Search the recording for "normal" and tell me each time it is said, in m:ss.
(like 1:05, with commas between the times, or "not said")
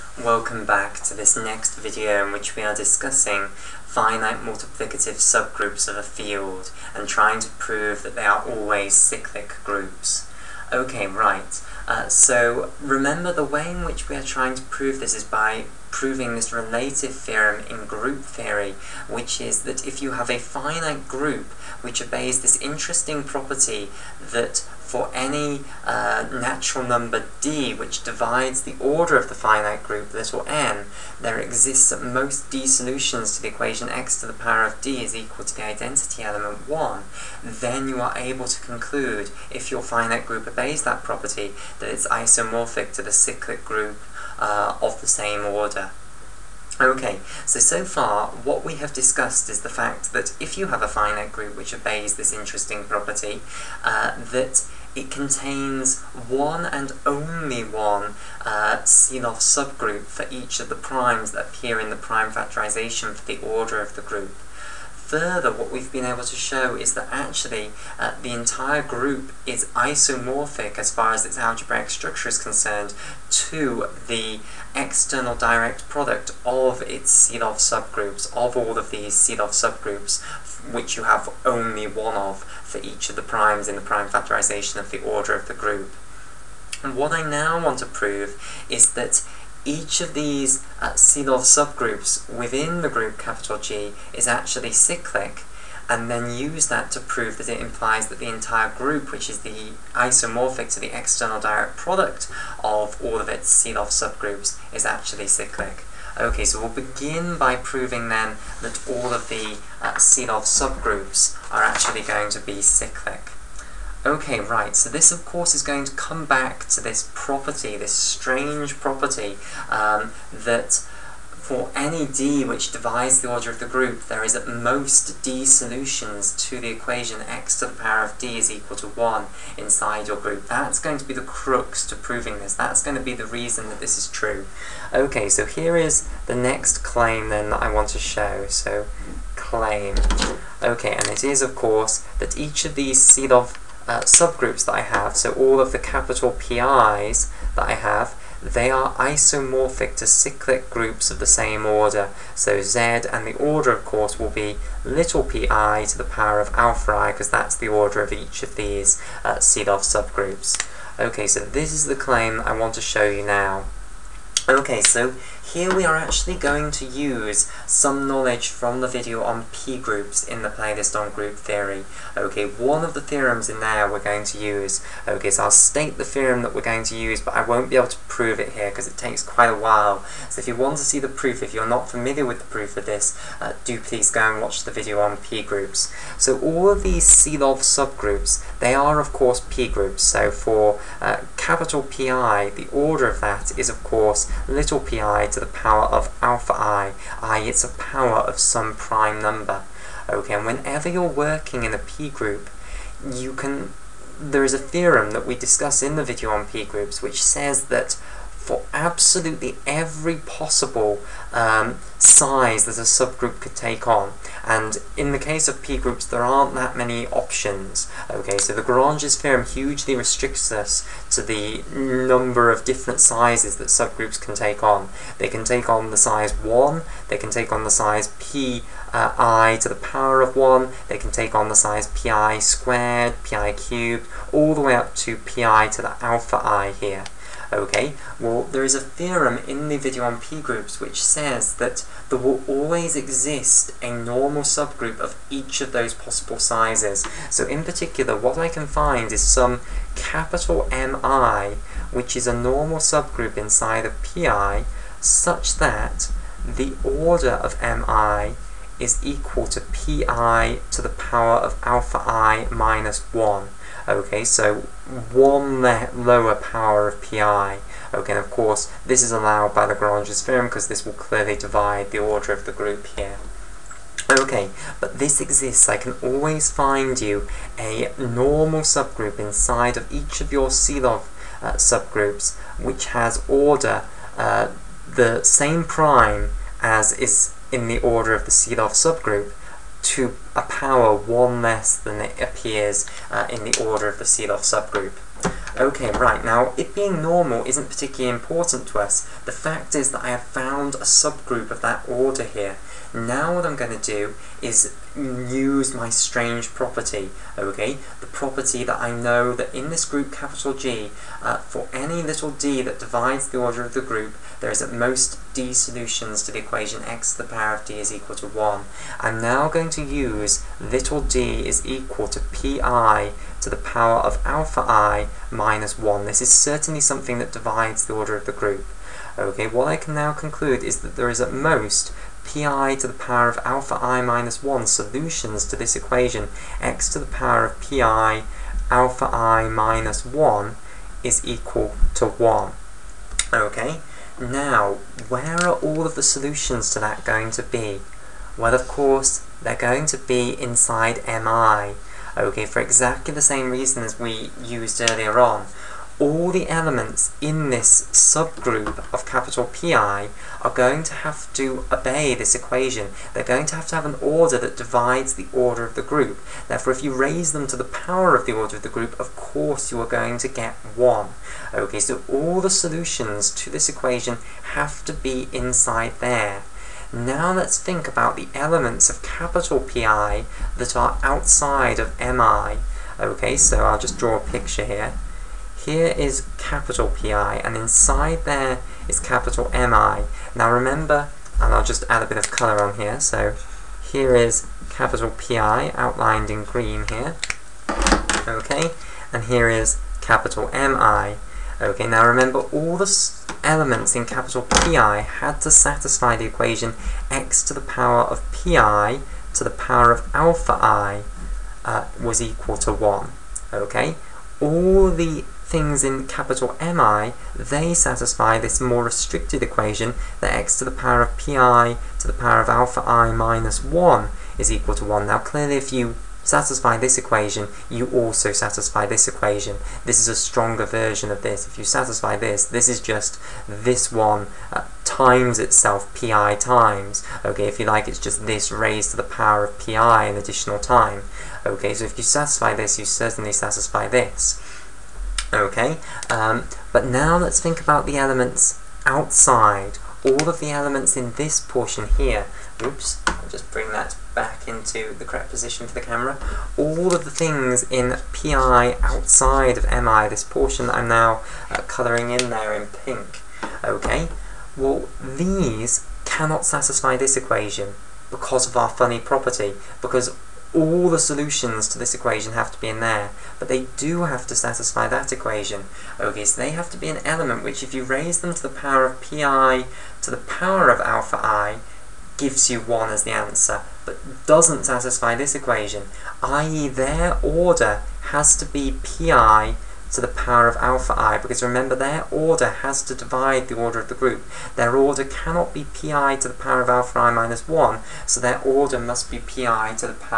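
4:03, 4:12, 4:37, 4:57.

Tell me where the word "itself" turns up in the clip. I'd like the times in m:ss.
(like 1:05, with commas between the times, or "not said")
7:15.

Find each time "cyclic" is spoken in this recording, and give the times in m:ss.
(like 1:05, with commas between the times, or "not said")
0:08, 0:43, 1:34, 1:45, 1:52, 2:30.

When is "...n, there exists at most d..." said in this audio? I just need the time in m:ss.
0:30.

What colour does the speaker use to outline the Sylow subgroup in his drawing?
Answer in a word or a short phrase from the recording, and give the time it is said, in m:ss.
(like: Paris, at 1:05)
green, at 6:36.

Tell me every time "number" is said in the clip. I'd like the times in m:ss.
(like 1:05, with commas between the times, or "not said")
0:26, 3:19, 3:41.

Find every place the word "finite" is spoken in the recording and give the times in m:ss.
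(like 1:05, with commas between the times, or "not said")
0:03, 0:20, 0:29, 0:39, 0:50.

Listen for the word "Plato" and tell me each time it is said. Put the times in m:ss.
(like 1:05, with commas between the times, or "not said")
not said.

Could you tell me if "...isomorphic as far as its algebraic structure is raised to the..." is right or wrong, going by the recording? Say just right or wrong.
wrong.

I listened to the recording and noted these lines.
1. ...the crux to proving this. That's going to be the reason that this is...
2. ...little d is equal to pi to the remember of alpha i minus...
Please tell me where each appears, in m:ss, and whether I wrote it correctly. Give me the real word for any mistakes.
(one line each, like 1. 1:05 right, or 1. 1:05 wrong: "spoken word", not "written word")
1. 2:11 right
2. 5:20 wrong: "power", not "remember".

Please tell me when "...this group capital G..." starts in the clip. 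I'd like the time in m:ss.
5:09.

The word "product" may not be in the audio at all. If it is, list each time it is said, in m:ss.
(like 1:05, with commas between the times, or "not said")
1:15, 1:41.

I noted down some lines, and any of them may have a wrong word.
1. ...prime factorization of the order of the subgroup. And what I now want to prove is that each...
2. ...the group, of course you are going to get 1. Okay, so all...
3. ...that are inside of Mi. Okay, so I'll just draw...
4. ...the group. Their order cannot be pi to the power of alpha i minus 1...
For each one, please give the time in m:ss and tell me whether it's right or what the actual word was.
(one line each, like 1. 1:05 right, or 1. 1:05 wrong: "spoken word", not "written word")
1. 1:23 wrong: "group", not "subgroup"
2. 6:08 right
3. 6:20 wrong: "outside", not "inside"
4. 8:13 right.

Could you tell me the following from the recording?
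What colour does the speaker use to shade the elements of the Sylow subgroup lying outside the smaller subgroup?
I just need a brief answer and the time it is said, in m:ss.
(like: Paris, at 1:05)
pink, at 7:42.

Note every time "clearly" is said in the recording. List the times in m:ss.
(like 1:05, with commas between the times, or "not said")
4:30, 7:05.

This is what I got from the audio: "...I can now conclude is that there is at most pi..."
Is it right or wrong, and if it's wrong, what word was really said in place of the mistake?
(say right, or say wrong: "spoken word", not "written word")
right.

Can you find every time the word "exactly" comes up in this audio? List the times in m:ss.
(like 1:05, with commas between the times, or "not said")
5:52.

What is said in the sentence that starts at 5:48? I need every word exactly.
Well, of course, they're going to be inside mi.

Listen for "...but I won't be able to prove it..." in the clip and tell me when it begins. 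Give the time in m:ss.
2:57.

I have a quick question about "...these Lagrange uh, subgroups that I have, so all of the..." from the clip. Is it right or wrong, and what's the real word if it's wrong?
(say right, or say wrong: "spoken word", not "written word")
wrong: "Sylow", not "Lagrange".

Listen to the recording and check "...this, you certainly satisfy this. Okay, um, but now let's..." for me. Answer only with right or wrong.
right.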